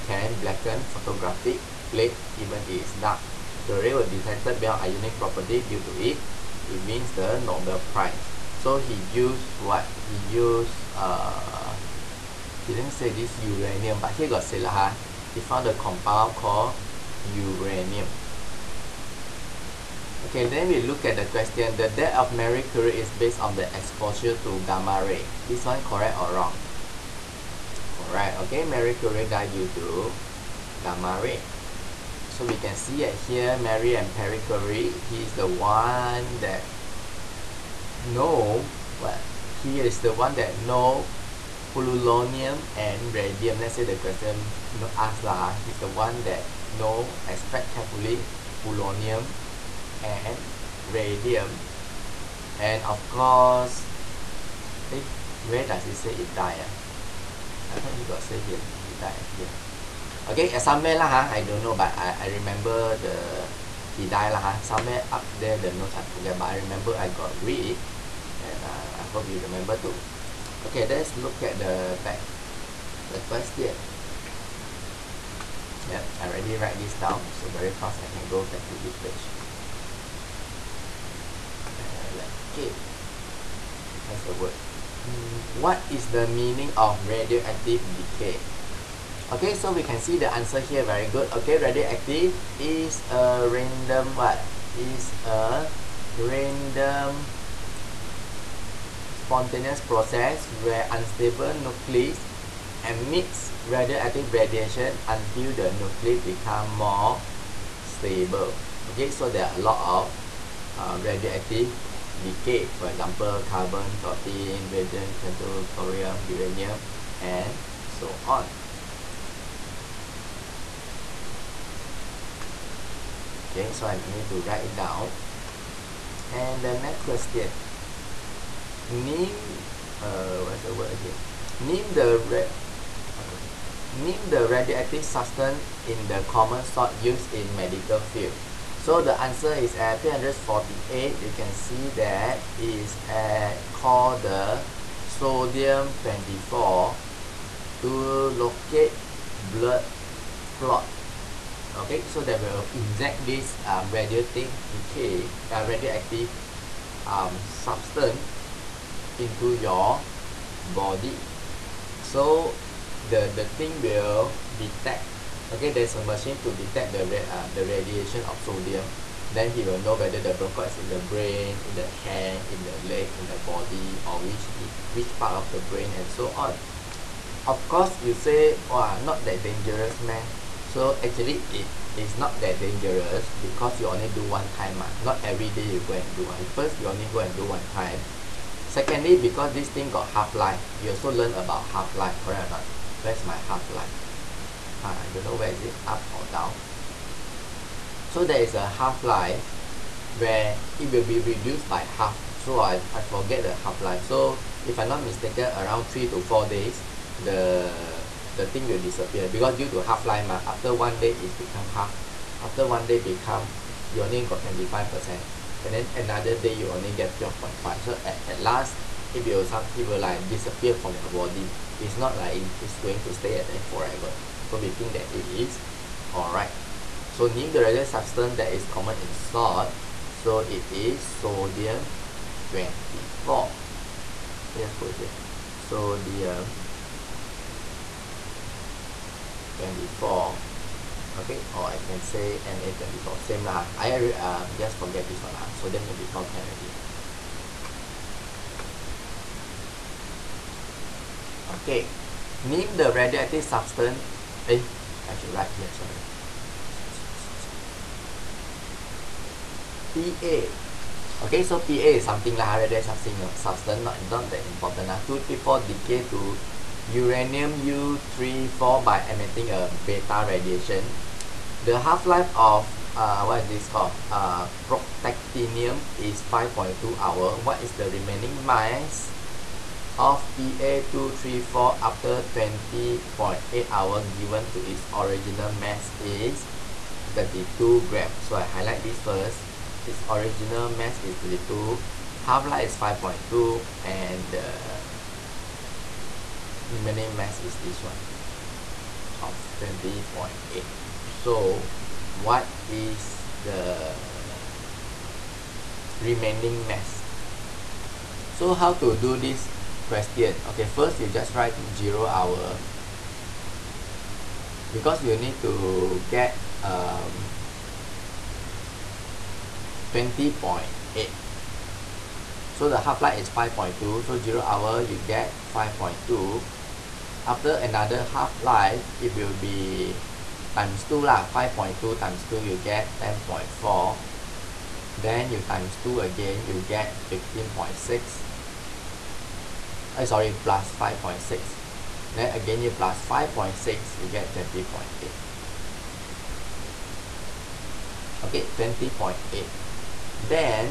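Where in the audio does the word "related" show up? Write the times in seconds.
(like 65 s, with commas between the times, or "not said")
227 s.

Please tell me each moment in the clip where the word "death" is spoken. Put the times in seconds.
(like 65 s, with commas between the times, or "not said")
21 s.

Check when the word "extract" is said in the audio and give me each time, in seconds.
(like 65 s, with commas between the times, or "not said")
47 s.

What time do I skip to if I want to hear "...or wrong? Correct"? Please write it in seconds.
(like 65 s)
26 s.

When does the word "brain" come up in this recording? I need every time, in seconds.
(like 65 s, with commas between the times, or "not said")
170 s, 175 s.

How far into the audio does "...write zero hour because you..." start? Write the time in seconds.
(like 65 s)
311 s.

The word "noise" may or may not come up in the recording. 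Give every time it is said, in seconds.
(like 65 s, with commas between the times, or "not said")
not said.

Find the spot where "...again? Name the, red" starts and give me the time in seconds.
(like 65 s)
130 s.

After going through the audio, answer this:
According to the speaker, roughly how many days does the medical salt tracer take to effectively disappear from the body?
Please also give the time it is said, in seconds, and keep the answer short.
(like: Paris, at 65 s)
3 to 4 days, at 205 s.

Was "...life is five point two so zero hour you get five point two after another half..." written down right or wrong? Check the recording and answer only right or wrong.
right.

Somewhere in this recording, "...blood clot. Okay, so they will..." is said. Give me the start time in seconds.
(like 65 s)
149 s.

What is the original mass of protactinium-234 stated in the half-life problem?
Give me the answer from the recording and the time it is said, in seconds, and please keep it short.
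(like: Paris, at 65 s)
32 grams, at 287 s.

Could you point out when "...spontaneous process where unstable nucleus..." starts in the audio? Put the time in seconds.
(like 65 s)
99 s.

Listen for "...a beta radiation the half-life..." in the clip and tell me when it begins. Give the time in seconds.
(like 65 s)
269 s.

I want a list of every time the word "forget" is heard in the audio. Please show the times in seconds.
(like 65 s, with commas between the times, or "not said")
66 s, 202 s, 244 s.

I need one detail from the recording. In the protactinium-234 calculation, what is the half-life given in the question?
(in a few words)
5.2 hours.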